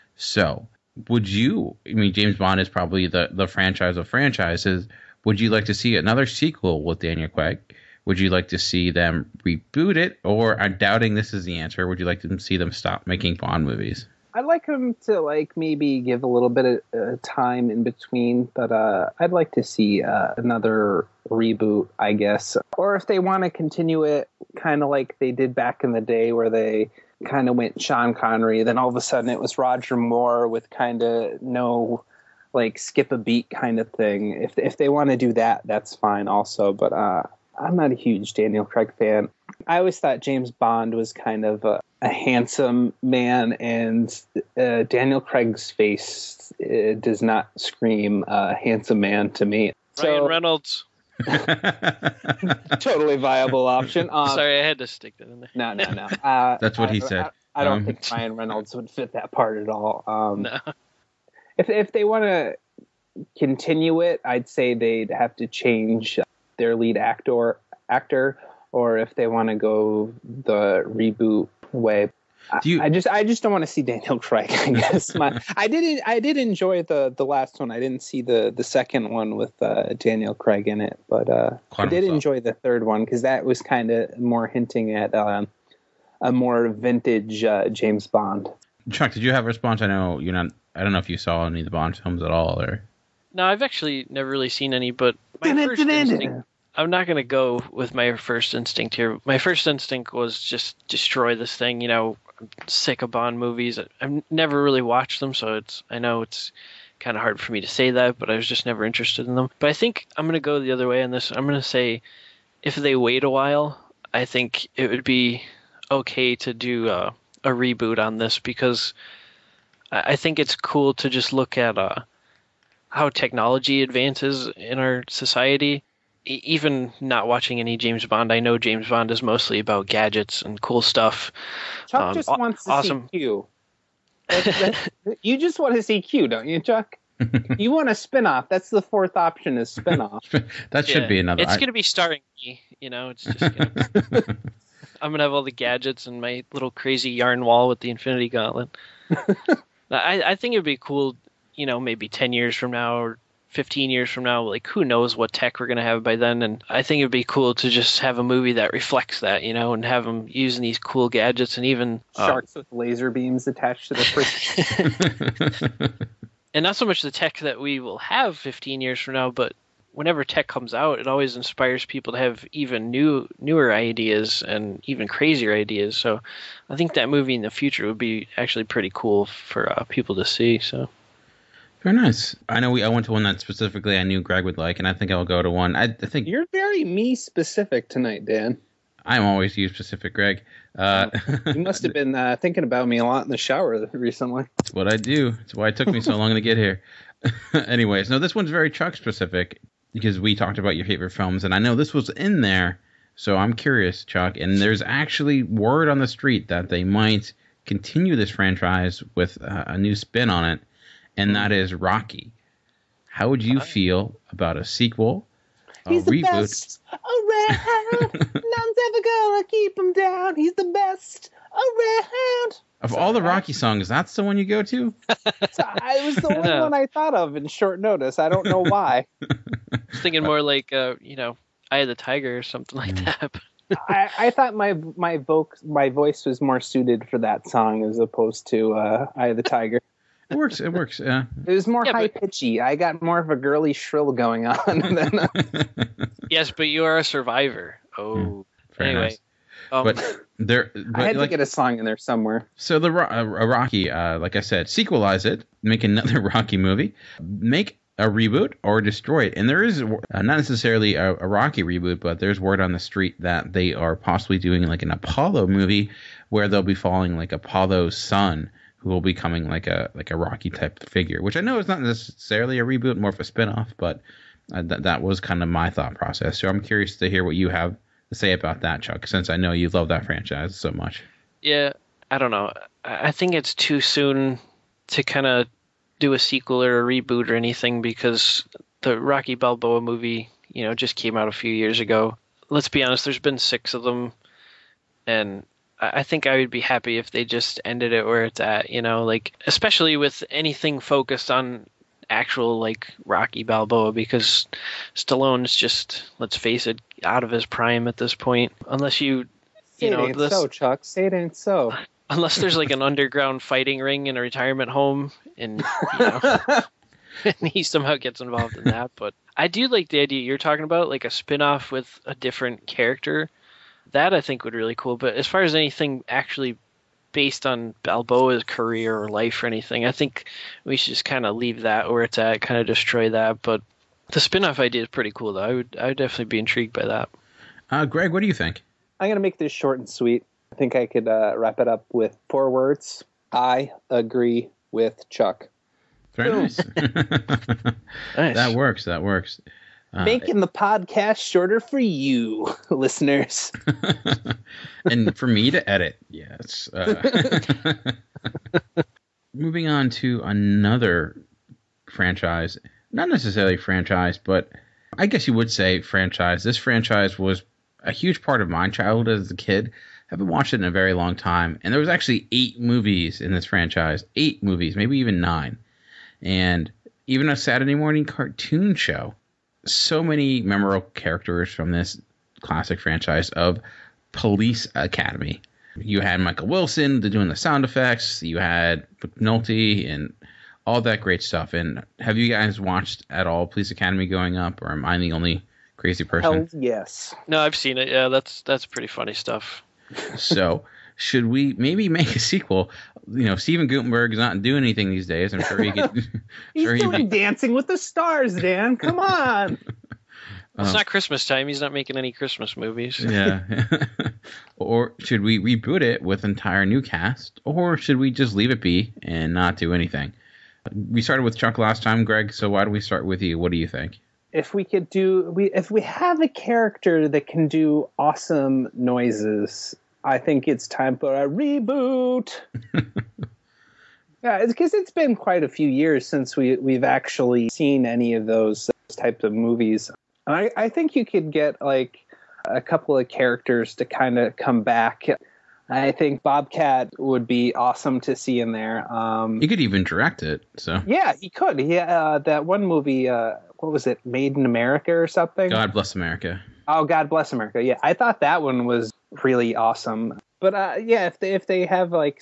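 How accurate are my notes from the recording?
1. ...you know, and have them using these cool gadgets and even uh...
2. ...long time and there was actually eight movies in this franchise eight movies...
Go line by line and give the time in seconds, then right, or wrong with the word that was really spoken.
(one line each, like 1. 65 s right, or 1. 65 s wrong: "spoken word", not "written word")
1. 159 s right
2. 370 s right.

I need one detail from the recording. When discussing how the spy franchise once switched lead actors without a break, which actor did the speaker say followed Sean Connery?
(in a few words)
Roger Moore.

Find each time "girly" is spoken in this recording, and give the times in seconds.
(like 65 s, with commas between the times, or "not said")
243 s.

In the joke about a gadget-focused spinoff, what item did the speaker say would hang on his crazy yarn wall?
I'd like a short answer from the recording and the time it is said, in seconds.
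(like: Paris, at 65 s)
Infinity Gauntlet, at 147 s.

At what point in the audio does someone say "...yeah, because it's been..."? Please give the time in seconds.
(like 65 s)
434 s.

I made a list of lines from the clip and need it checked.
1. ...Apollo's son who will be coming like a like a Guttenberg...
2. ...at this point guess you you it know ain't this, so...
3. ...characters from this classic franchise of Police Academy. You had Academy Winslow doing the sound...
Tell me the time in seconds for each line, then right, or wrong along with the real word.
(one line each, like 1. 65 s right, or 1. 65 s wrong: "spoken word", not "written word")
1. 267 s wrong: "Rocky", not "Guttenberg"
2. 307 s wrong: "unless", not "guess"
3. 380 s wrong: "Michael", not "Academy".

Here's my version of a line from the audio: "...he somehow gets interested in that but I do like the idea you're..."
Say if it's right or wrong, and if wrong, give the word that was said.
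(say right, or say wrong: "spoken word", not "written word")
wrong: "involved", not "interested".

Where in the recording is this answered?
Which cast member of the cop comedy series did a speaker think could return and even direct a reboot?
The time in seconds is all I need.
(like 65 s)
446 s.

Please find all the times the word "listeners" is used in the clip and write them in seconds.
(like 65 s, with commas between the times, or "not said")
352 s.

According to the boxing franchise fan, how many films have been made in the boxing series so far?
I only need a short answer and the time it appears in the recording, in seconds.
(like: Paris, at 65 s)
6, at 293 s.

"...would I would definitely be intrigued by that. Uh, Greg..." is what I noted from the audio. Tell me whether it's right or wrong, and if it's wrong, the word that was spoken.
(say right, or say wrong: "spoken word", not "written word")
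right.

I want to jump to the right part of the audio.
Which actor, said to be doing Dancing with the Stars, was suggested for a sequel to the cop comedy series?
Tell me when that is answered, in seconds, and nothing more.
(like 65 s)
403 s.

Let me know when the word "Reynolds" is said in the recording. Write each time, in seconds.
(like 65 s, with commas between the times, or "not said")
50 s, 58 s.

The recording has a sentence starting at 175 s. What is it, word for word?
So I think that movie in the future would be actually pretty cool for uh, people to see.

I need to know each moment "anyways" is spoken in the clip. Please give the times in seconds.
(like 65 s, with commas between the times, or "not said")
197 s, 248 s.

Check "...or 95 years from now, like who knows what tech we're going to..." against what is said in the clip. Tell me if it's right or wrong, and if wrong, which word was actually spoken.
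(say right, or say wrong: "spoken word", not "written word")
wrong: "15", not "95".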